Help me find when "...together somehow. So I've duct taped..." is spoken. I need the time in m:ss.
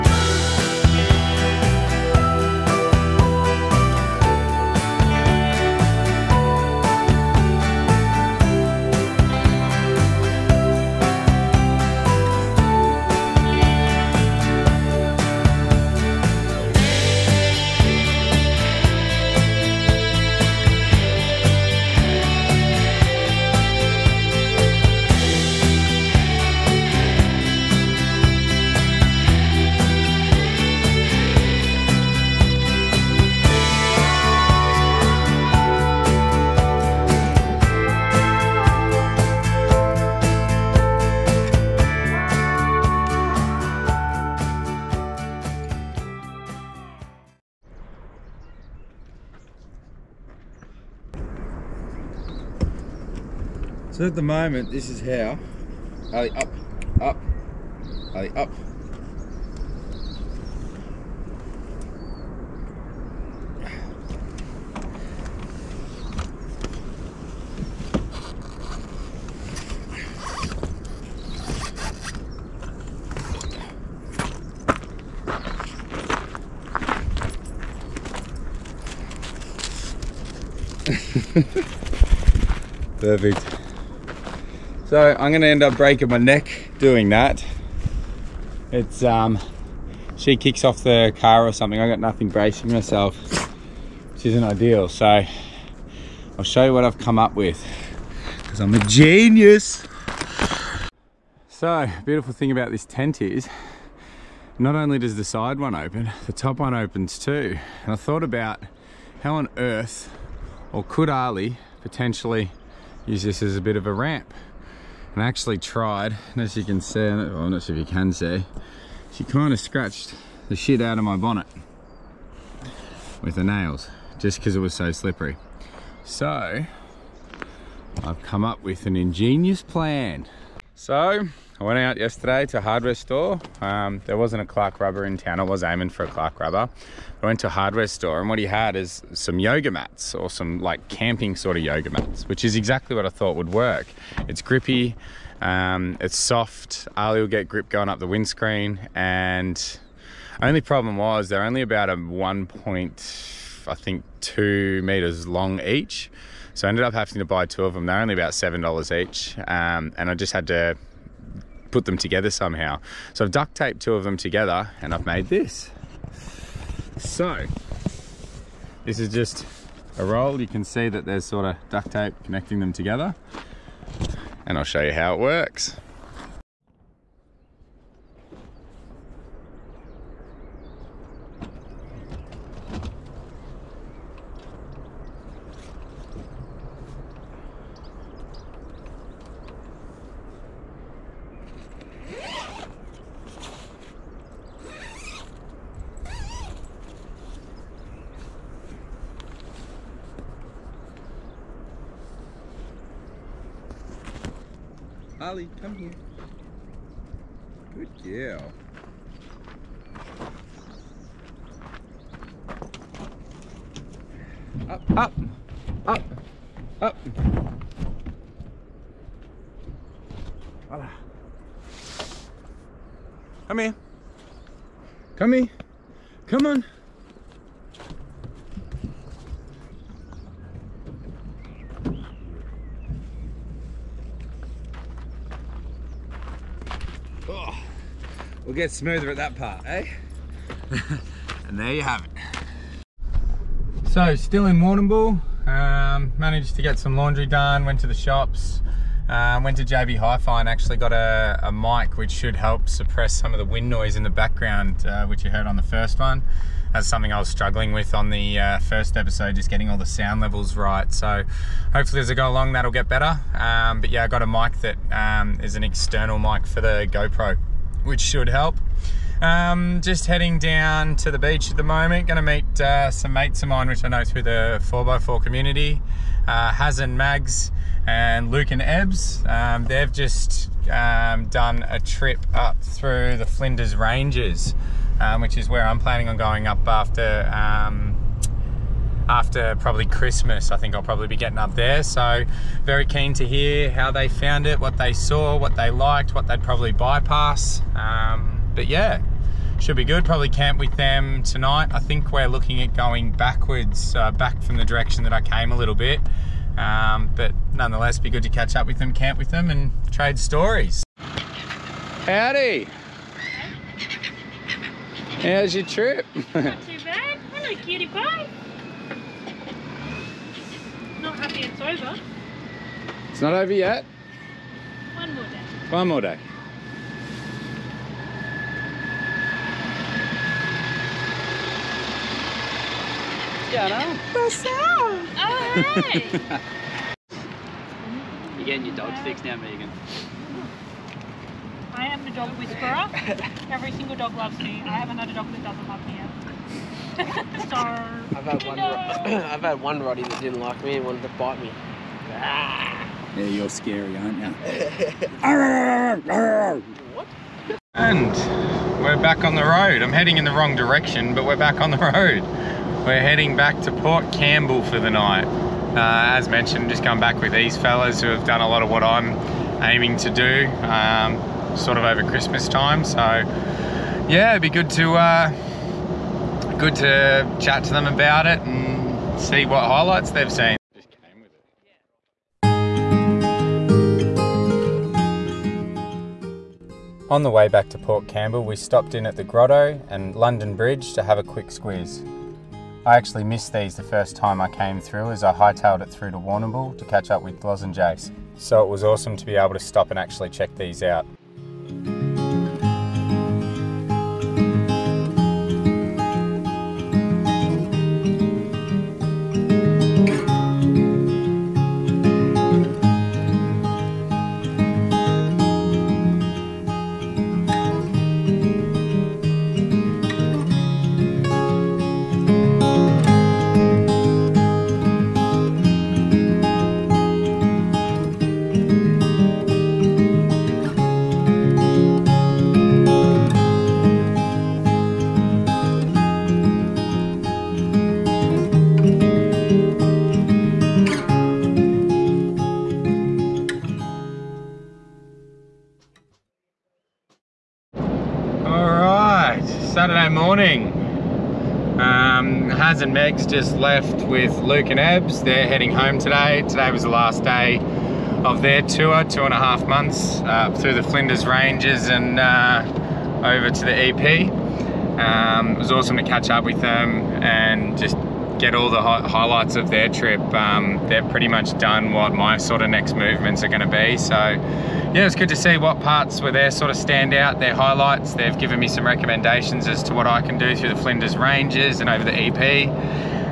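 2:41.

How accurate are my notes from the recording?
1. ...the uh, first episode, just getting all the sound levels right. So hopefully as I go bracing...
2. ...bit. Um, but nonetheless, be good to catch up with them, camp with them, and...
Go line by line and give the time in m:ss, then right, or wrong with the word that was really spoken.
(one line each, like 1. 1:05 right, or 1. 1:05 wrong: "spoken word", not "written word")
1. 4:18 wrong: "along", not "bracing"
2. 5:05 right.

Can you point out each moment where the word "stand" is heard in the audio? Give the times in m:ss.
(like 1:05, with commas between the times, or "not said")
7:56.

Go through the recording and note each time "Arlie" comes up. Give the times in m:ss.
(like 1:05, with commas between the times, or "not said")
1:51, 2:26.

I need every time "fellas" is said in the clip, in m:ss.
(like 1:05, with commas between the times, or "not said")
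6:07.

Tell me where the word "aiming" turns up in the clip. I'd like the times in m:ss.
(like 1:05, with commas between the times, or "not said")
2:15, 6:09.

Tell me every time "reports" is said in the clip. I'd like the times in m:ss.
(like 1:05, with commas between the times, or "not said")
not said.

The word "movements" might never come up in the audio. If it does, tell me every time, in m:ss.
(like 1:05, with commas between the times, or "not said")
7:52.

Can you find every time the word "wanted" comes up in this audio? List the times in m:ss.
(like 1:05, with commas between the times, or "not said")
5:50.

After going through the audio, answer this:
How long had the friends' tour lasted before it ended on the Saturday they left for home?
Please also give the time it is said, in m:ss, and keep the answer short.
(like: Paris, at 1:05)
2 and a half months, at 7:39.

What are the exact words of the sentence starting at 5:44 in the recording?
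I have another dog that doesn't love me.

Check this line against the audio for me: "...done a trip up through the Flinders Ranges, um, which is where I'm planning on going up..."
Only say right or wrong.
right.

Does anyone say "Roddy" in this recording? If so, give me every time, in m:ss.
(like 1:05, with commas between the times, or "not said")
5:49.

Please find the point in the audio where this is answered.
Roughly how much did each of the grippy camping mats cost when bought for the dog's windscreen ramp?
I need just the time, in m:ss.
2:38.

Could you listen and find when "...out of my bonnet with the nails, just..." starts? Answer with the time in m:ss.
2:00.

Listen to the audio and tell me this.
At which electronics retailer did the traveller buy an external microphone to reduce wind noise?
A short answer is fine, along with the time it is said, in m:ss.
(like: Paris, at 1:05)
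JB Hi-Fi, at 4:09.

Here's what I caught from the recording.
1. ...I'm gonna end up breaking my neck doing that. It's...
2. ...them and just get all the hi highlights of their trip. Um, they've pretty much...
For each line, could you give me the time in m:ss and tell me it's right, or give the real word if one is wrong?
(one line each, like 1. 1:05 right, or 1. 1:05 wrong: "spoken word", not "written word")
1. 1:25 right
2. 7:46 right.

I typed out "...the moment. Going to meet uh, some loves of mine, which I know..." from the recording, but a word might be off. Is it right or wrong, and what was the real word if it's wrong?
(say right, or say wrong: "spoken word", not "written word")
wrong: "mates", not "loves".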